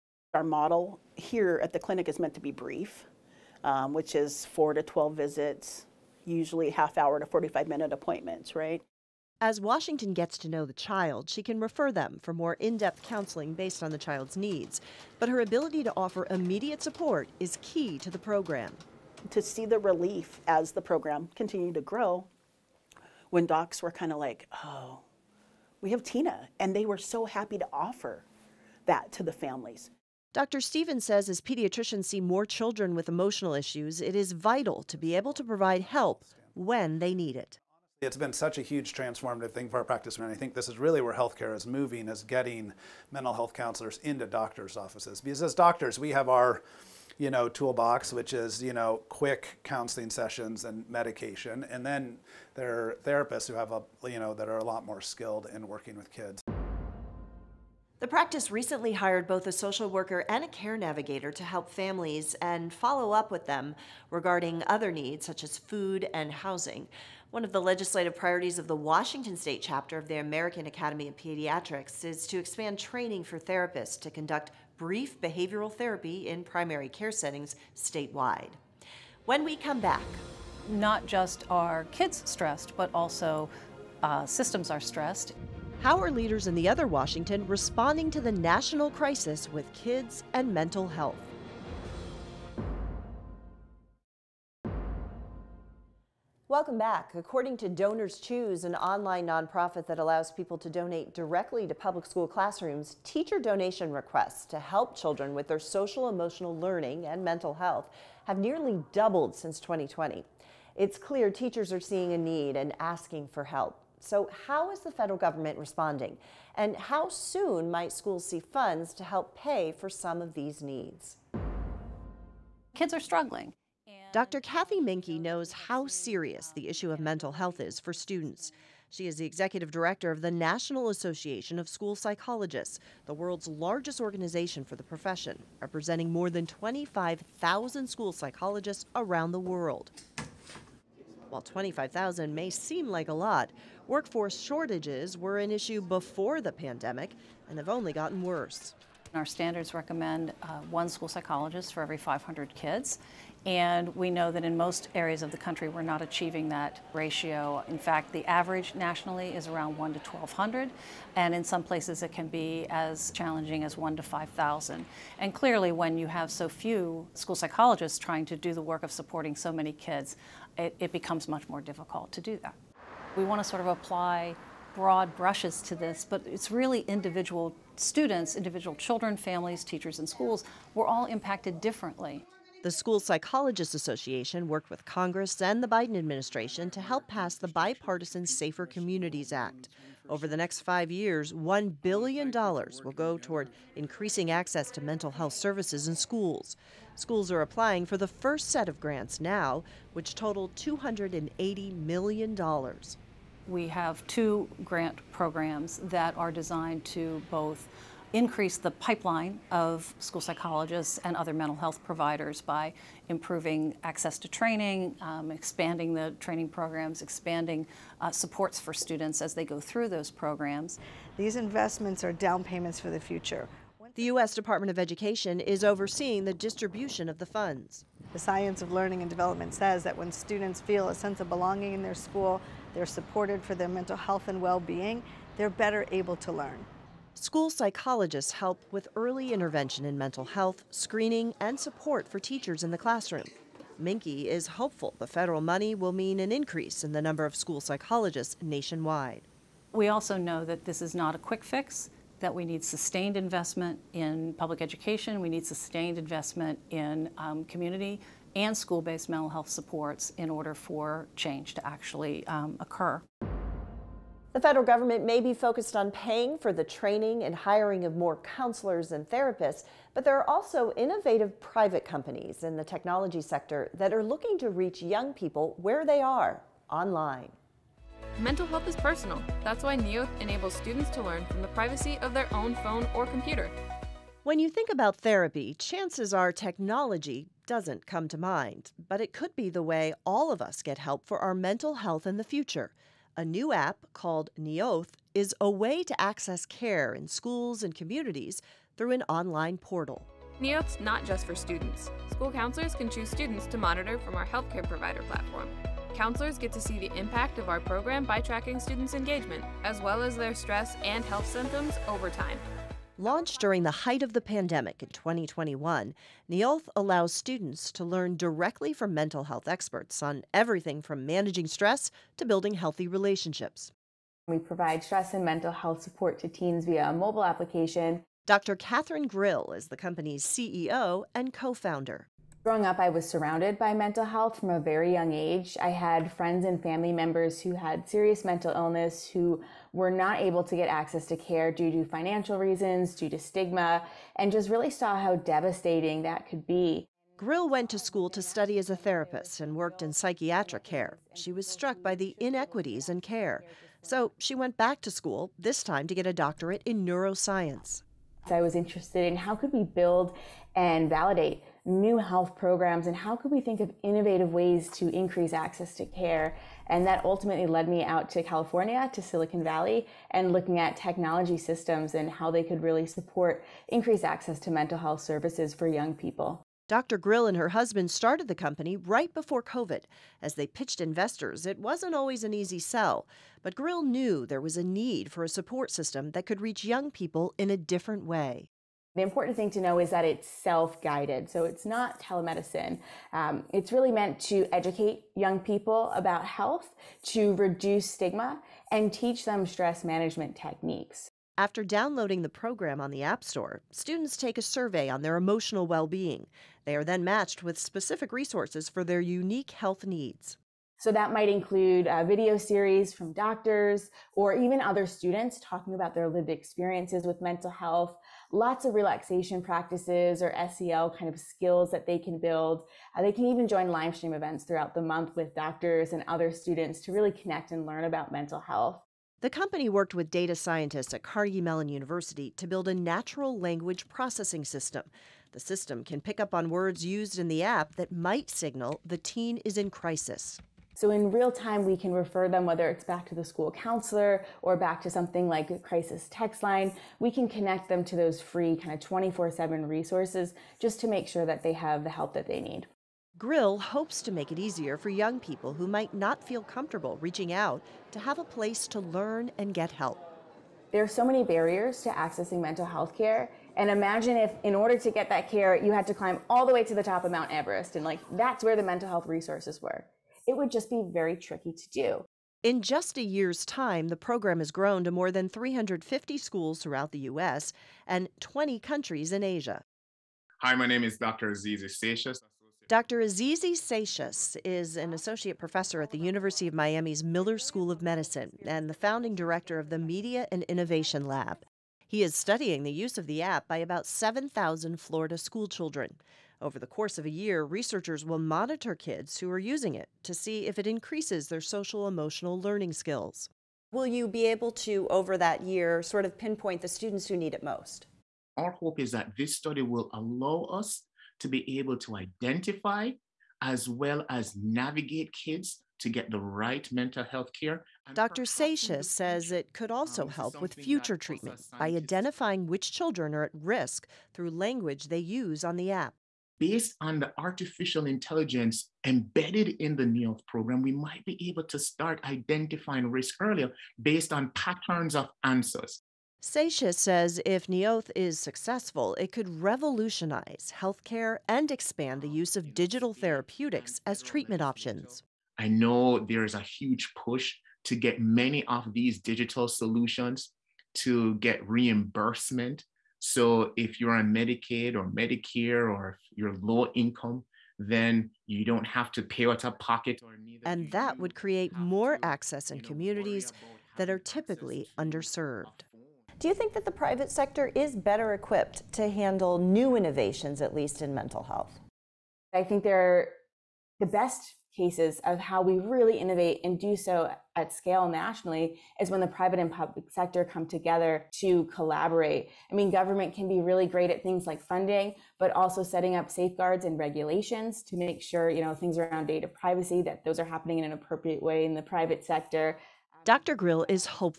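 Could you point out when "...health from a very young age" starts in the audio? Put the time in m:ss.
5:34.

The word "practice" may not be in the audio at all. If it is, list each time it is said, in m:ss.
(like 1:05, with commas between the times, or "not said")
0:39, 0:58, 6:59.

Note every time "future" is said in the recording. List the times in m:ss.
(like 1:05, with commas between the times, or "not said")
3:42, 4:52, 8:40.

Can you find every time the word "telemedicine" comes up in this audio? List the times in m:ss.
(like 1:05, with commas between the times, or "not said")
6:31.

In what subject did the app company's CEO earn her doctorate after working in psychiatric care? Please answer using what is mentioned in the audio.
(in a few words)
neuroscience.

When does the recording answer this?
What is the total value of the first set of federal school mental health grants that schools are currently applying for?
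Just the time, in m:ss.
3:20.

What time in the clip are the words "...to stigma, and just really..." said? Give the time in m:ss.
5:43.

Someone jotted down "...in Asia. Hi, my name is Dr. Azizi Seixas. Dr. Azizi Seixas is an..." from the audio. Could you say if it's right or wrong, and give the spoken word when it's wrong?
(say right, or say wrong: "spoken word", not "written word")
right.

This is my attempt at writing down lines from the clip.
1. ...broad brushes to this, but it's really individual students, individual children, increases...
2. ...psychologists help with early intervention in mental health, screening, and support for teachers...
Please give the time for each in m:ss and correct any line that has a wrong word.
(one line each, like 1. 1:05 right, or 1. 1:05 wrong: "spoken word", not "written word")
1. 2:54 wrong: "families", not "increases"
2. 3:57 right.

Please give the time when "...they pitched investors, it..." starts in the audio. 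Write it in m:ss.
6:20.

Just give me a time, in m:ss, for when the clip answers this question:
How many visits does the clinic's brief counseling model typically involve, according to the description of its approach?
0:04.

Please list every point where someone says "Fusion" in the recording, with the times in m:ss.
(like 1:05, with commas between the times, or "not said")
not said.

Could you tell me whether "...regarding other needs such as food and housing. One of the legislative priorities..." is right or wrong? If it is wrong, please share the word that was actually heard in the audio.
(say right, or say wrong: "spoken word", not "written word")
right.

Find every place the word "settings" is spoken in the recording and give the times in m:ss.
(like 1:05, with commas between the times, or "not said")
1:17, 9:45.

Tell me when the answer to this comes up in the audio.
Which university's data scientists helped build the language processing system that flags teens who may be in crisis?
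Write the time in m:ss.
7:11.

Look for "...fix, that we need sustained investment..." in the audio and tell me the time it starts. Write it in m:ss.
4:11.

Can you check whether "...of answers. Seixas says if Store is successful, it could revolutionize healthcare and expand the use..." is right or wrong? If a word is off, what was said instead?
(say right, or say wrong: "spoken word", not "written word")
wrong: "Neolth", not "Store".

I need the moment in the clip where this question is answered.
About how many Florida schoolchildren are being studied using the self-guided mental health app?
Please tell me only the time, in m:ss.
8:13.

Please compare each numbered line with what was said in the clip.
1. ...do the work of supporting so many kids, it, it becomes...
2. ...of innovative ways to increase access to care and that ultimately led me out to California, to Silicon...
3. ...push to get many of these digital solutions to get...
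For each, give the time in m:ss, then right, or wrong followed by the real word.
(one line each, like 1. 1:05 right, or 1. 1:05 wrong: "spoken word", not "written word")
1. 2:48 right
2. 6:03 right
3. 9:06 right.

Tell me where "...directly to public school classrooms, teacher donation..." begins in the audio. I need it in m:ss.
1:41.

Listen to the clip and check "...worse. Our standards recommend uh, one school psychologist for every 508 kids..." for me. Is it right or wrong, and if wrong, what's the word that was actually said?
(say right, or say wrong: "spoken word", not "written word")
wrong: "500", not "508".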